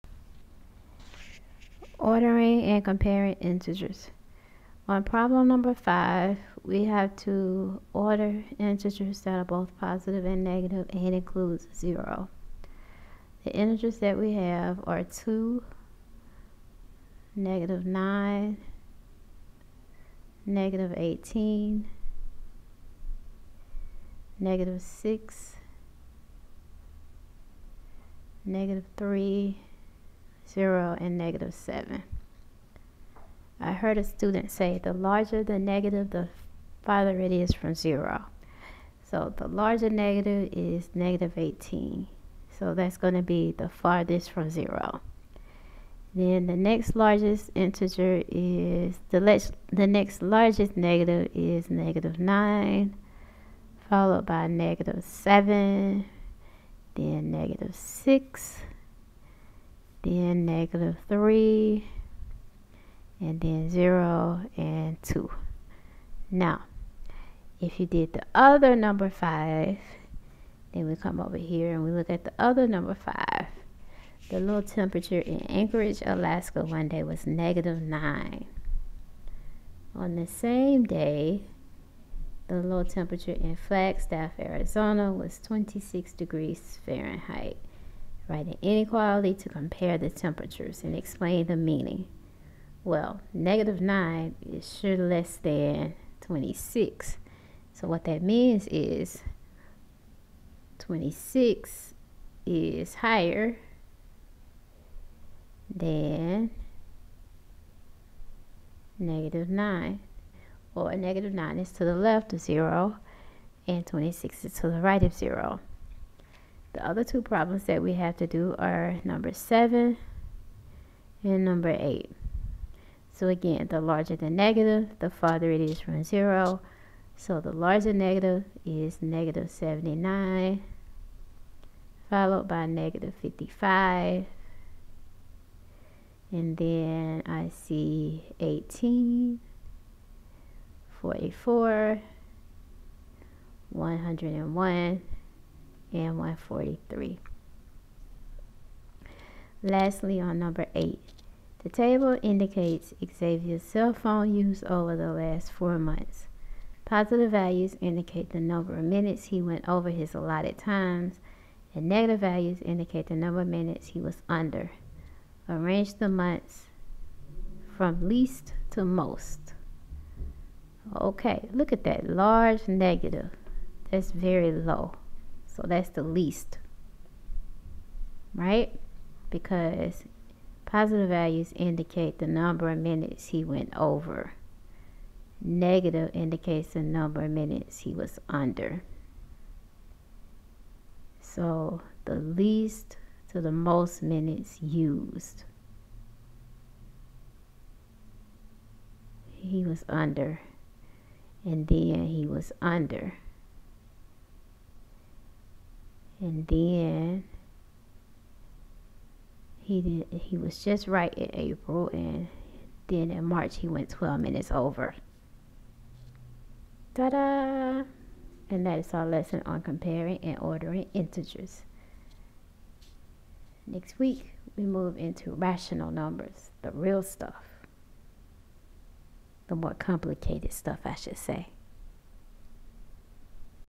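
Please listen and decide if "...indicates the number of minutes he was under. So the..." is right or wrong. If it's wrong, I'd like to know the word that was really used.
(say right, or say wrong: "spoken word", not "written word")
right.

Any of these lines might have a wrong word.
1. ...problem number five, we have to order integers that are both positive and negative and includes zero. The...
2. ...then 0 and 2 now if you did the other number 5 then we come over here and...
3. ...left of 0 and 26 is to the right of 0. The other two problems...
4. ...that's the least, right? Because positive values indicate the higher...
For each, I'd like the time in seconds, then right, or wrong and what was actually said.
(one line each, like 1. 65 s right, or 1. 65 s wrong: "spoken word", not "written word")
1. 5 s right
2. 63 s right
3. 111 s right
4. 175 s wrong: "number", not "higher".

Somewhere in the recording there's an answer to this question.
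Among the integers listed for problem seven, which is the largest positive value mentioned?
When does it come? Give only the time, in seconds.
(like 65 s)
146 s.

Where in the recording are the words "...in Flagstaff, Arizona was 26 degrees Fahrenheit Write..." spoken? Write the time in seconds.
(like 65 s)
83 s.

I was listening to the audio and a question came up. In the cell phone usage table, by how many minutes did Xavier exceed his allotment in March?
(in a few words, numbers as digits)
12.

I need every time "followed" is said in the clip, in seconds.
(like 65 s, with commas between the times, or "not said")
53 s, 132 s.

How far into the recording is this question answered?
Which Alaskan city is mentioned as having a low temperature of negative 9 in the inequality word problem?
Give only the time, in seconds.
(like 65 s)
75 s.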